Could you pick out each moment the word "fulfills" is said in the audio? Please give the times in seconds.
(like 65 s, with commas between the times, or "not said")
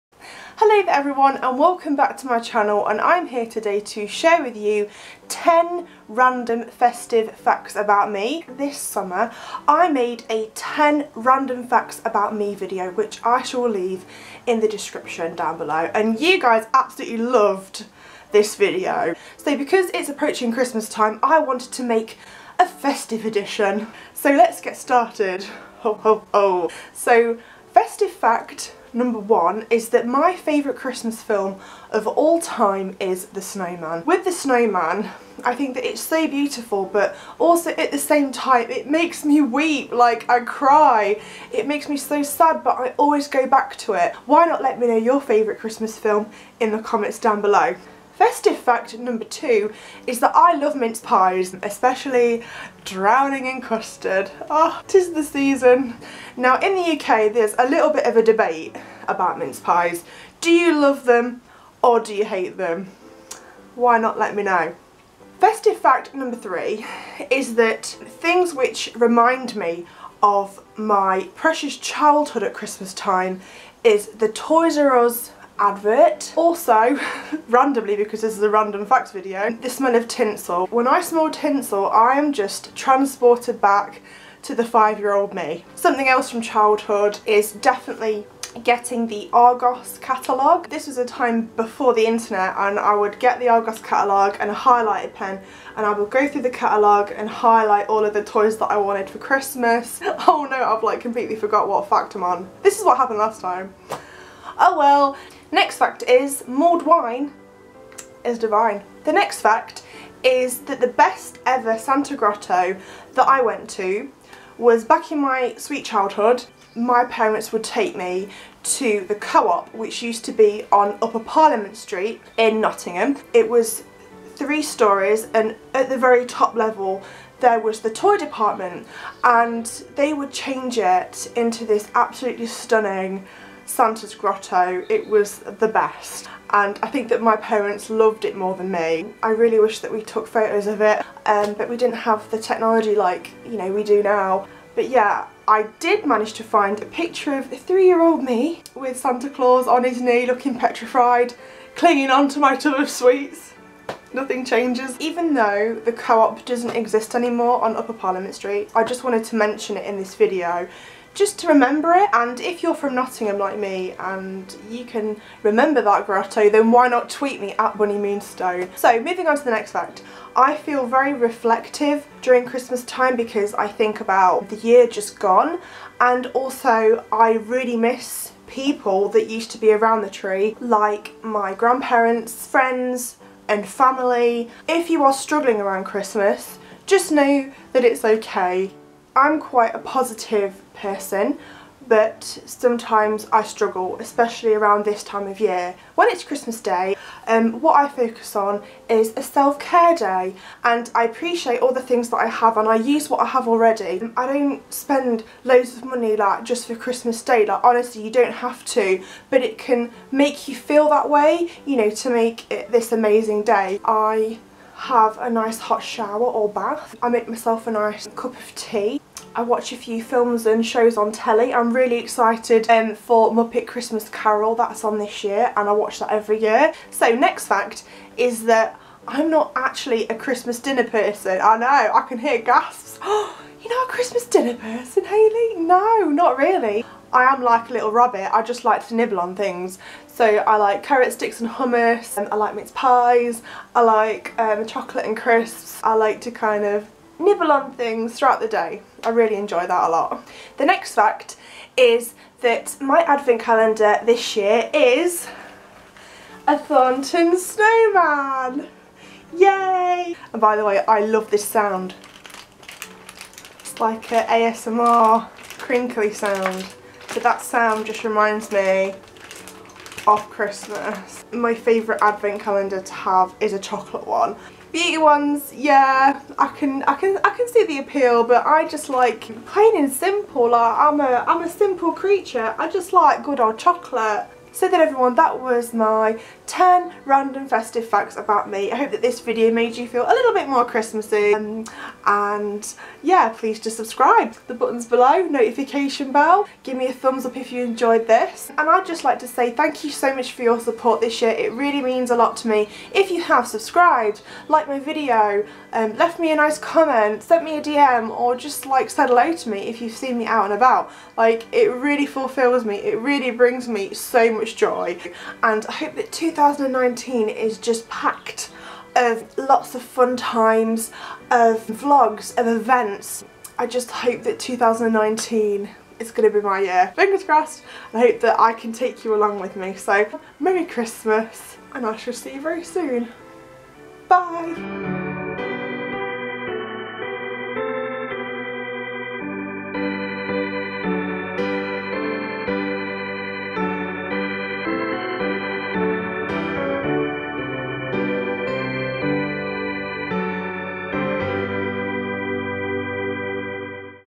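312 s.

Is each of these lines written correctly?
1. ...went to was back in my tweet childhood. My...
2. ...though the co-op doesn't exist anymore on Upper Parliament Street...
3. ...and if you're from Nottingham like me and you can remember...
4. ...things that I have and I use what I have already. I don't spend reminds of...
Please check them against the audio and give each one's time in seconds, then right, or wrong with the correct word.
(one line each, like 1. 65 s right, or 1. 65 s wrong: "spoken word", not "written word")
1. 113 s wrong: "sweet", not "tweet"
2. 155 s right
3. 162 s right
4. 201 s wrong: "loads", not "reminds".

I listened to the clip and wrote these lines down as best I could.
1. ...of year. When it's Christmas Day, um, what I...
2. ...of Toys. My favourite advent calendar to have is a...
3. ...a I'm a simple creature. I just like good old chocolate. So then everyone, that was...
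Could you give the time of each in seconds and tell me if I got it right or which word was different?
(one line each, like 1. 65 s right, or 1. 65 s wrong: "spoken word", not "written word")
1. 195 s right
2. 270 s wrong: "Christmas", not "Toys"
3. 281 s right.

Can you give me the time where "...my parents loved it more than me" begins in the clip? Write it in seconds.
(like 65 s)
137 s.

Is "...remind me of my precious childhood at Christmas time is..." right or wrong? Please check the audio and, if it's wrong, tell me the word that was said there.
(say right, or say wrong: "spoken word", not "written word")
right.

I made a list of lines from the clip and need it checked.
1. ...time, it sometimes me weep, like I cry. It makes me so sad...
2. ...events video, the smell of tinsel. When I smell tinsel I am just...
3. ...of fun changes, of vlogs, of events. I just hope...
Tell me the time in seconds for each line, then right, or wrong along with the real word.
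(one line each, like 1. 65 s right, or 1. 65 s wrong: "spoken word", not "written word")
1. 38 s wrong: "makes", not "sometimes"
2. 78 s wrong: "facts", not "events"
3. 319 s wrong: "times", not "changes".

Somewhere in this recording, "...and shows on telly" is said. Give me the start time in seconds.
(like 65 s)
220 s.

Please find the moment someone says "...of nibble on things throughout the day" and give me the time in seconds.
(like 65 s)
246 s.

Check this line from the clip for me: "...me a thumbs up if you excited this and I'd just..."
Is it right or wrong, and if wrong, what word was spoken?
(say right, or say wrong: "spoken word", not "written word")
wrong: "enjoyed", not "excited".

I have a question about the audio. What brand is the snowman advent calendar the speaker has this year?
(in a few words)
Thornton.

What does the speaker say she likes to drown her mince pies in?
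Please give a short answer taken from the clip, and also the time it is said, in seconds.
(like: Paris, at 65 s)
Custard, at 53 s.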